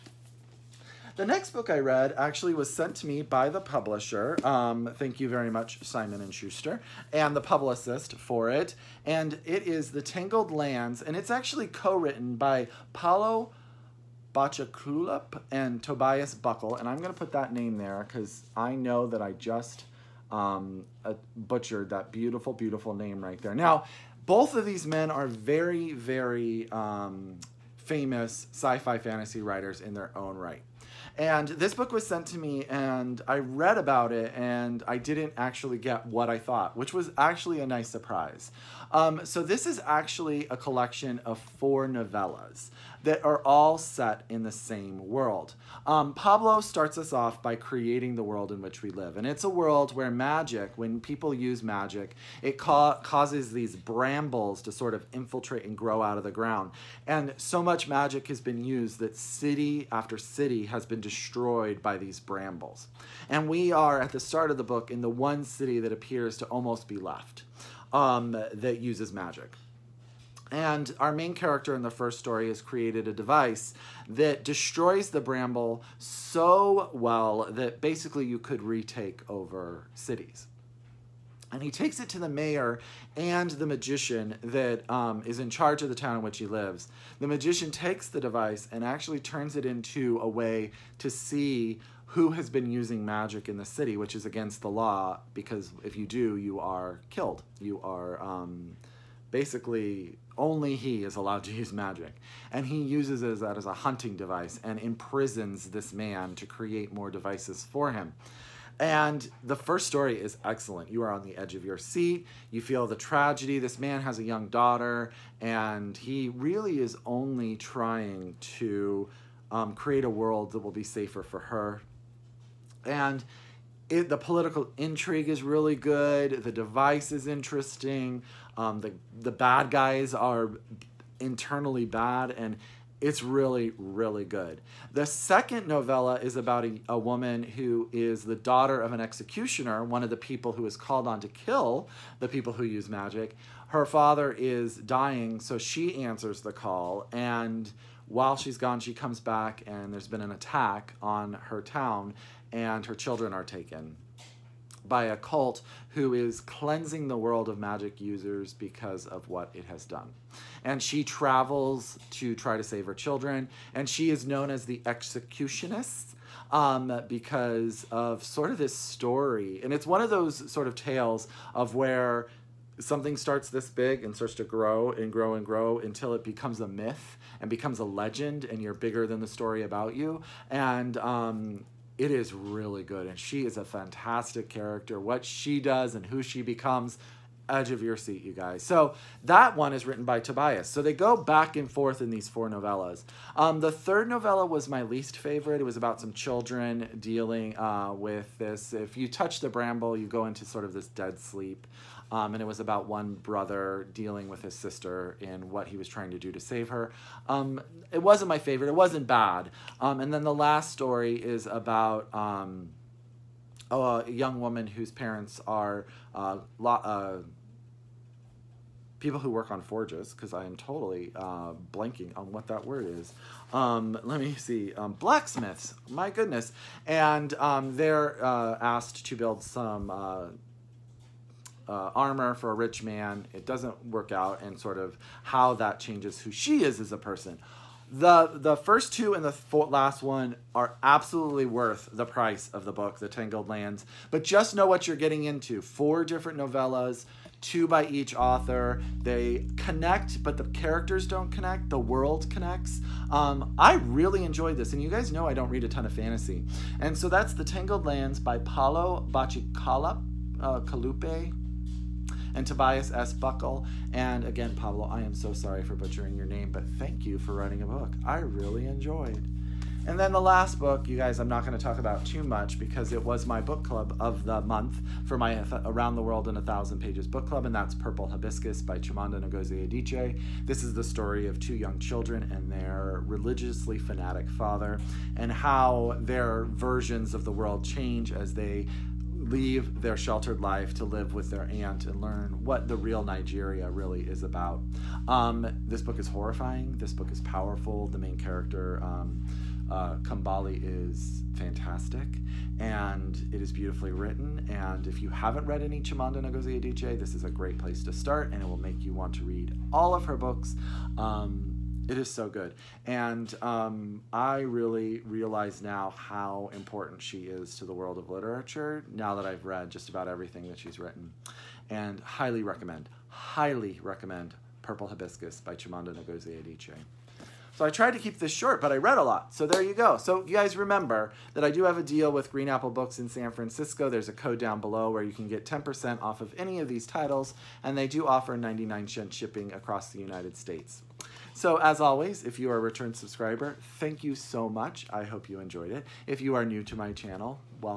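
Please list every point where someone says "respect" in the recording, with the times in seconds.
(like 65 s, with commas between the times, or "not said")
not said.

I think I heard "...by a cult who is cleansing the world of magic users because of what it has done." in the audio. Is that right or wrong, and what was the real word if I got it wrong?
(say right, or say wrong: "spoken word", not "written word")
right.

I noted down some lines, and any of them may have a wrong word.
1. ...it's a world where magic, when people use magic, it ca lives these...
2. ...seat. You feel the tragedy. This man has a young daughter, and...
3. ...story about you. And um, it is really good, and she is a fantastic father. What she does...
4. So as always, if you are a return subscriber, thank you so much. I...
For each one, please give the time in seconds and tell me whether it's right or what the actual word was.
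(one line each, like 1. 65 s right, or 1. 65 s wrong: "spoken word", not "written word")
1. 49 s wrong: "causes", not "lives"
2. 111 s right
3. 179 s wrong: "character", not "father"
4. 341 s right.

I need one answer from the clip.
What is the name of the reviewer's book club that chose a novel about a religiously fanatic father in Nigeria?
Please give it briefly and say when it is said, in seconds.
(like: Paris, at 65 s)
Around the World in a Thousand Pages, at 275 s.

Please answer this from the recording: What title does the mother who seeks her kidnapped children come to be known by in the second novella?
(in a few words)
the executionist.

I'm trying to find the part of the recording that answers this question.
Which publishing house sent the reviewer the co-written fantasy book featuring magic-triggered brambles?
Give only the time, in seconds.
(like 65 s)
5 s.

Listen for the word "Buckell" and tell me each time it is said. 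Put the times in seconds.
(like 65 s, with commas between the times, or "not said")
16 s, 263 s.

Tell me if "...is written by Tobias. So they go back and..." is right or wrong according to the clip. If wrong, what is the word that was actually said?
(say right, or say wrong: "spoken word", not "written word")
right.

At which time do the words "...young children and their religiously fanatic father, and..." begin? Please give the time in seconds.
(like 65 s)
281 s.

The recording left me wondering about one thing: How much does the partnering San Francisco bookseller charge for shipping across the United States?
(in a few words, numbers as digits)
99 cents.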